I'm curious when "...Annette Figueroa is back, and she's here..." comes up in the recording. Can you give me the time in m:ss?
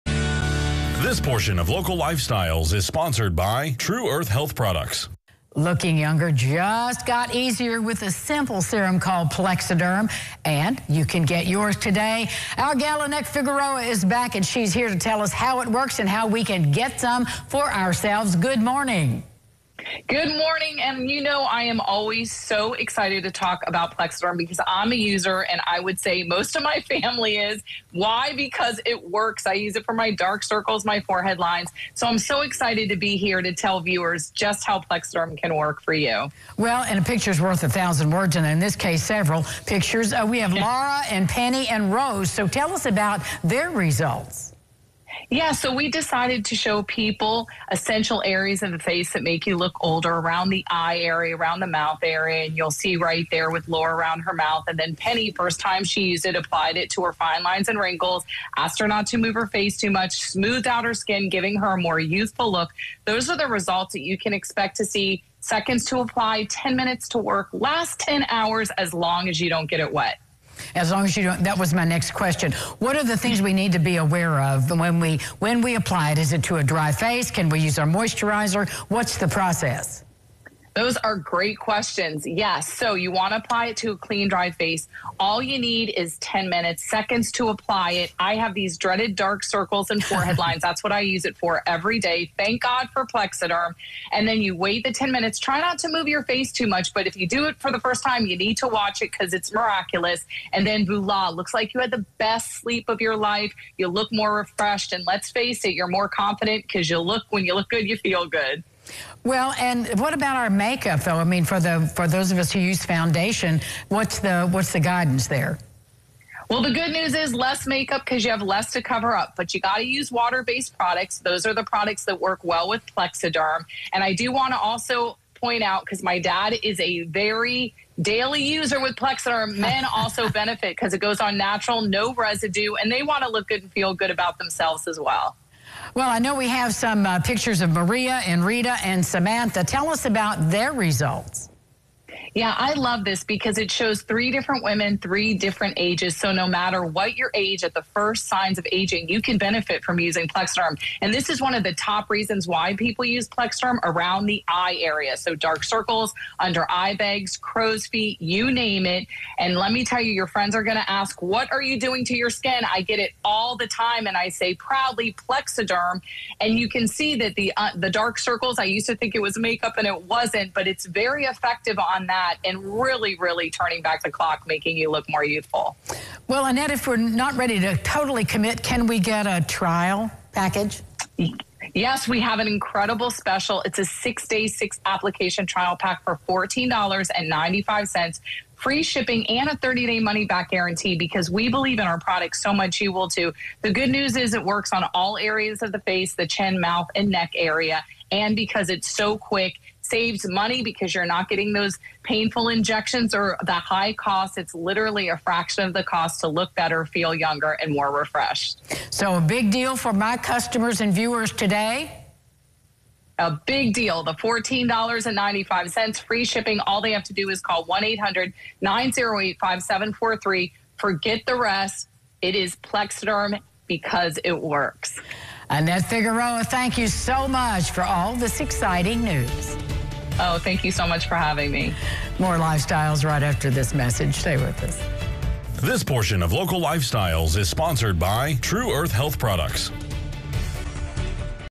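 0:13.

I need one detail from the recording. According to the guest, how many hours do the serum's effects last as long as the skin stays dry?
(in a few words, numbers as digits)
10.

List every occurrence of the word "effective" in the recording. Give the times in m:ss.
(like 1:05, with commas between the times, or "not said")
2:51.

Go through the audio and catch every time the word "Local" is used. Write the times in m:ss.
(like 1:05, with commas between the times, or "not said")
0:01, 3:56.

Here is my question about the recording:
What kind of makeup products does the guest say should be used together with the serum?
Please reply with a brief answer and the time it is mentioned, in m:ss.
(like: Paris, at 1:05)
water based products, at 2:00.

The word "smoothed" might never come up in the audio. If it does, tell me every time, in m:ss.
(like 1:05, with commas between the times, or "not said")
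1:00.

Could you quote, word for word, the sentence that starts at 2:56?
Well, Annette, if we're not ready to totally commit, can we get a trial package?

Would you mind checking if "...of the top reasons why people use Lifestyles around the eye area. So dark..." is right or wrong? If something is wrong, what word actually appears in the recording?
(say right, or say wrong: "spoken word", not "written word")
wrong: "Plexaderm", not "Lifestyles".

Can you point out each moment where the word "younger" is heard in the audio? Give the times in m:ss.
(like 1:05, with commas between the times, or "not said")
0:05, 3:27.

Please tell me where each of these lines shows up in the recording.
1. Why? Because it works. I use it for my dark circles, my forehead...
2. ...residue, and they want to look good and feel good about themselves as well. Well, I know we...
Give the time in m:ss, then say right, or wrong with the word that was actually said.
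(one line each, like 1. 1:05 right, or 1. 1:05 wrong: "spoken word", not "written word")
1. 0:27 right
2. 2:12 right.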